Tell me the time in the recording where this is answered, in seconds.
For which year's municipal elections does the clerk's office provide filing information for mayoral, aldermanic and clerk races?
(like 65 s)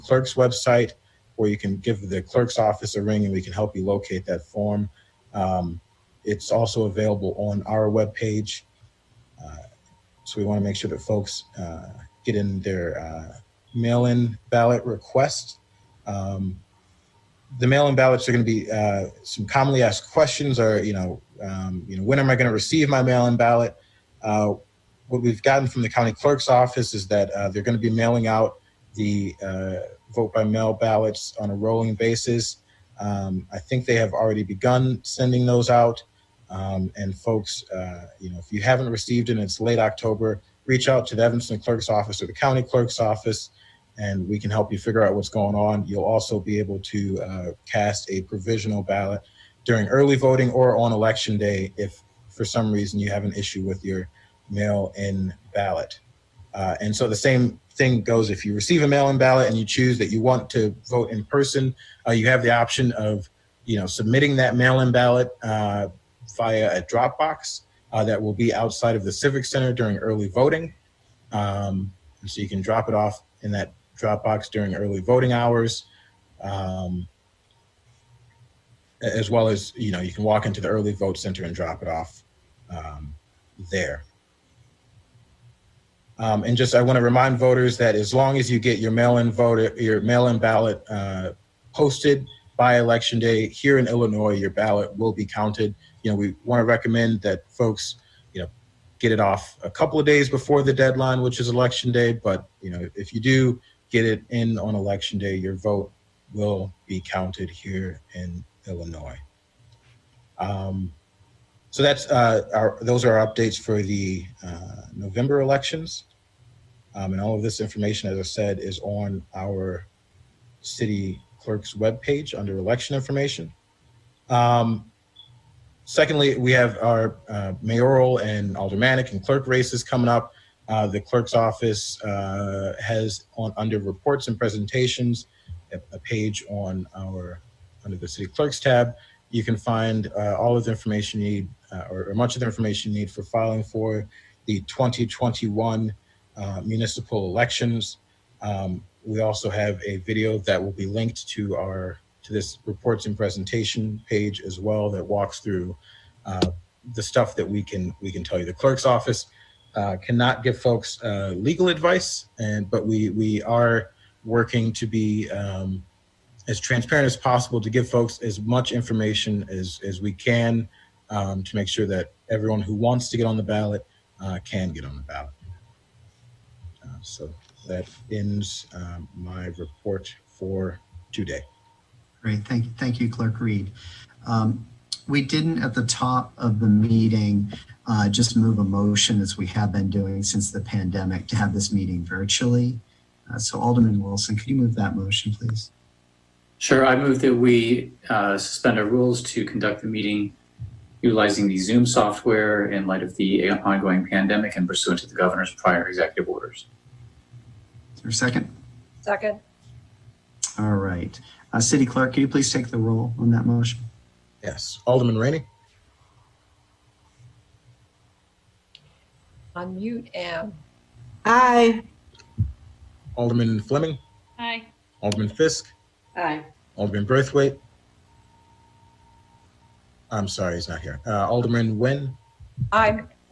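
144 s.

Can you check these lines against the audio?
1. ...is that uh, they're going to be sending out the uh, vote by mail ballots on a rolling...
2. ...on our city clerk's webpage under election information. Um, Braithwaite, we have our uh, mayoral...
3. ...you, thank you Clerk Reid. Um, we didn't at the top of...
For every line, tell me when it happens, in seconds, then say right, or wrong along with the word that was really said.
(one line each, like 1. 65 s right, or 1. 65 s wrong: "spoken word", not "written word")
1. 26 s wrong: "mailing", not "sending"
2. 118 s wrong: "Secondly", not "Braithwaite"
3. 182 s right.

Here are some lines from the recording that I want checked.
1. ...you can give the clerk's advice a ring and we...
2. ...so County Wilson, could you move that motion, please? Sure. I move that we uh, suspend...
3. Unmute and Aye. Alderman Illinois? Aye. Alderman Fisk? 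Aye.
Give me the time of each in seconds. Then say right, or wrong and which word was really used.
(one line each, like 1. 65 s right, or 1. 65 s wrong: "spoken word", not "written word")
1. 1 s wrong: "office", not "advice"
2. 193 s wrong: "Alderman", not "County"
3. 219 s wrong: "Fleming", not "Illinois".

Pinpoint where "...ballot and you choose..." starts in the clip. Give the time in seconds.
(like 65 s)
59 s.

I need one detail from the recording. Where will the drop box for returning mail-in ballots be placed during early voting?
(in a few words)
Outside of the Civic Center.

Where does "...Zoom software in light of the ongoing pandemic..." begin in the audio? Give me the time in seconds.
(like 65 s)
201 s.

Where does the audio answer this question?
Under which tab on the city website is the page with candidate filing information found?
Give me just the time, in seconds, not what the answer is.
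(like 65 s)
138 s.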